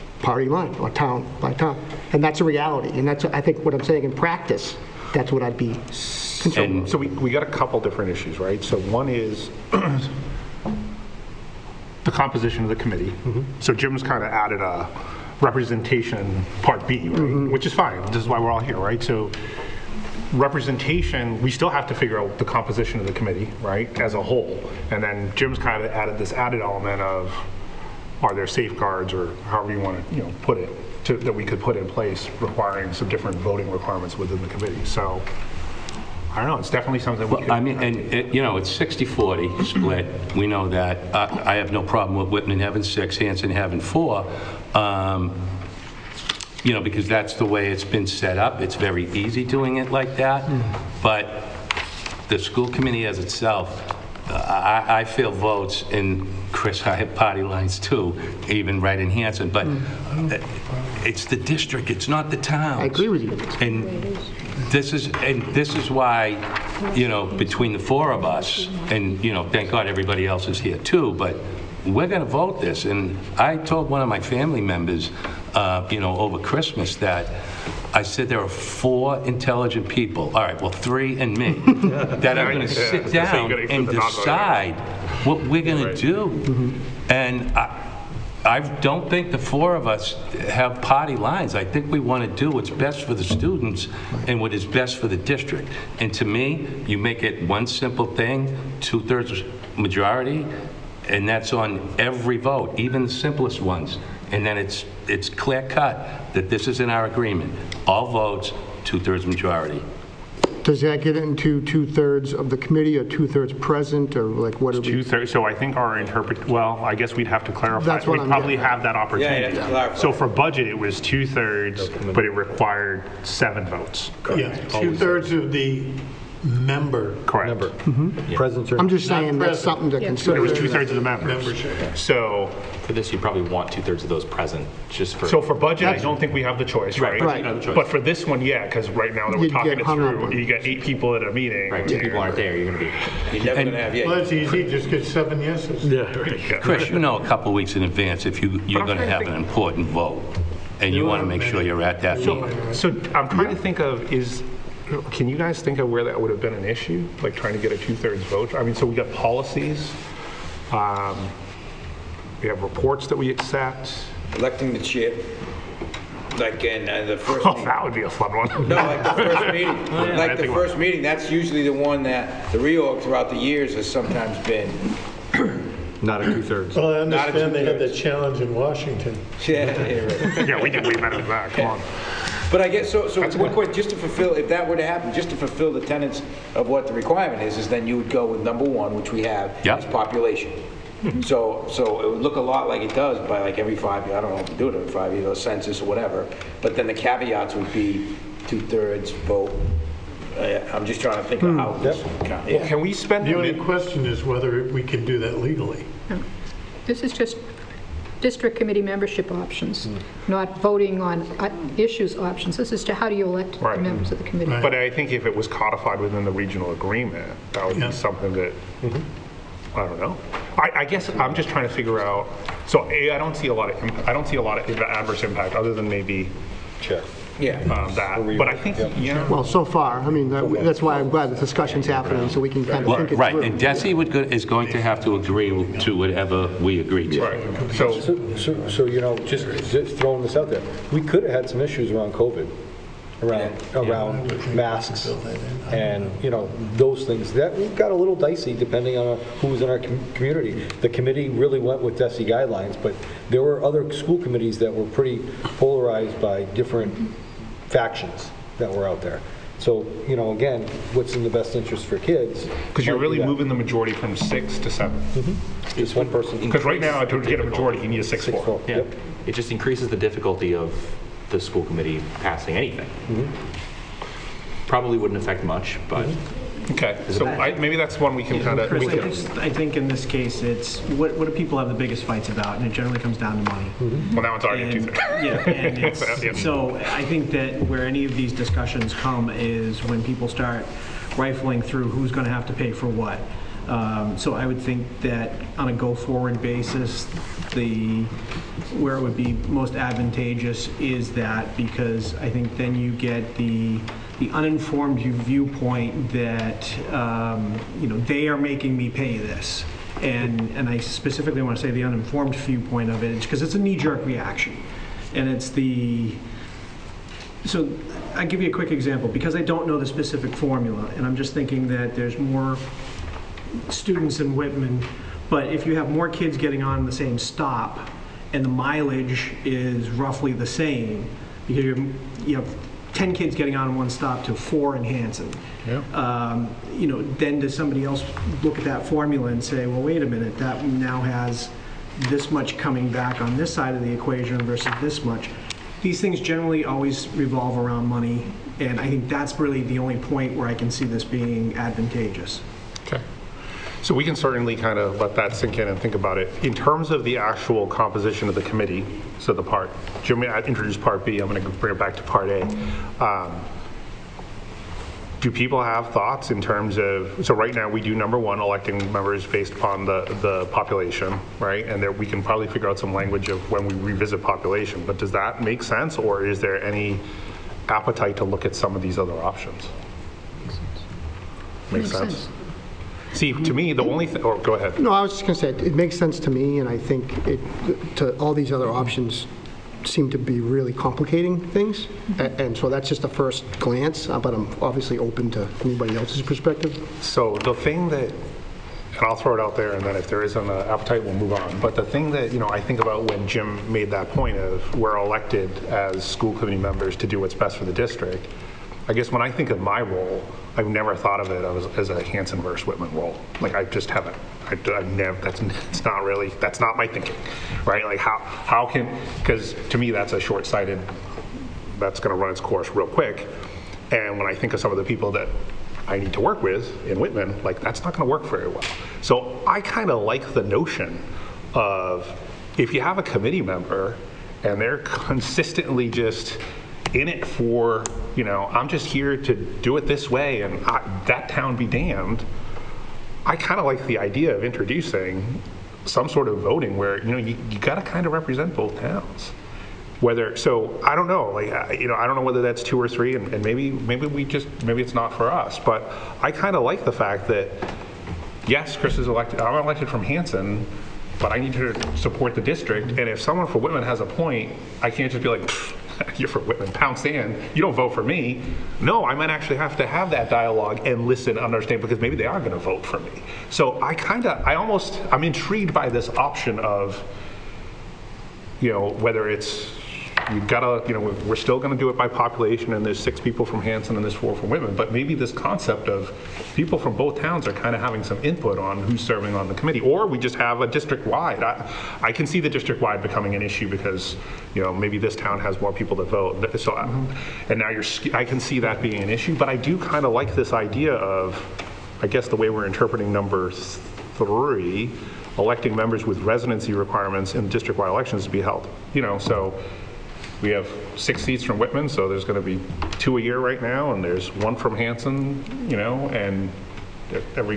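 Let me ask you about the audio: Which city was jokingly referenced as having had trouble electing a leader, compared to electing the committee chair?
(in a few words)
Washington.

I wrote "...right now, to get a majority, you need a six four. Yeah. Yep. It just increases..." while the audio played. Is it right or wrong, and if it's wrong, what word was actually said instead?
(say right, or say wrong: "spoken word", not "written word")
right.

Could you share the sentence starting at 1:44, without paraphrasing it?
And then it's, it's clear cut that this is in our agreement.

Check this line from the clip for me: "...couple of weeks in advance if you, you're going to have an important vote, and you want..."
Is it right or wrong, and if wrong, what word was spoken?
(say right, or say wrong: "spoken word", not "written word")
right.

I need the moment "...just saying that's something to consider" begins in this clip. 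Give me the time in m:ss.
2:08.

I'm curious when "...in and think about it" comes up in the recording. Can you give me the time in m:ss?
5:55.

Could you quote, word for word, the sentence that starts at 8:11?
I, I can see the district-wide becoming an issue because, you know, maybe this town has more people to vote.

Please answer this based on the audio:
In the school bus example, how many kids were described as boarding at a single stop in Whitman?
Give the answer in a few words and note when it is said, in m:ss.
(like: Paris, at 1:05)
10, at 5:32.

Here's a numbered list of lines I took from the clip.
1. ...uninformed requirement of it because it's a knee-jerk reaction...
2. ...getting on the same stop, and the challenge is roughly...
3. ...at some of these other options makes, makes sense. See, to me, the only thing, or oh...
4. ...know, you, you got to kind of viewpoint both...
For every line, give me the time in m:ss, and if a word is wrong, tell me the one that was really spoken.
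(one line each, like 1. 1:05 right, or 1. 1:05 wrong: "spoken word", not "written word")
1. 5:11 wrong: "viewpoint", not "requirement"
2. 5:26 wrong: "mileage", not "challenge"
3. 6:18 right
4. 7:27 wrong: "represent", not "viewpoint".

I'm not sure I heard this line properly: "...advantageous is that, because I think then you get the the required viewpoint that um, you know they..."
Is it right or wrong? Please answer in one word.
wrong.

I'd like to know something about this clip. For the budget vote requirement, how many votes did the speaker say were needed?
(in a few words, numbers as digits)
7.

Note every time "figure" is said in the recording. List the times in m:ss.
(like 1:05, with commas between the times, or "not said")
0:21, 3:41, 6:12.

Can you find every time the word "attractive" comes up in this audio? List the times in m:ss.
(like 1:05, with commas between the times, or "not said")
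not said.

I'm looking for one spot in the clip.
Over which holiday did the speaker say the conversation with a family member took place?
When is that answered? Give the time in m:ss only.
1:16.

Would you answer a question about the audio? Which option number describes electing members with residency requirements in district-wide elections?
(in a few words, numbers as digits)
3.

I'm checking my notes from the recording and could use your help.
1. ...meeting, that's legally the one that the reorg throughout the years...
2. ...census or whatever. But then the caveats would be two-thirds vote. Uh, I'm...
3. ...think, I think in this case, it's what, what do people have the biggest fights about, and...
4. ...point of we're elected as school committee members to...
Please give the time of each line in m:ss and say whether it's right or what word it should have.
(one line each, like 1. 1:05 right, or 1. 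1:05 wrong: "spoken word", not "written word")
1. 2:50 wrong: "usually", not "legally"
2. 3:15 right
3. 4:39 right
4. 6:44 right.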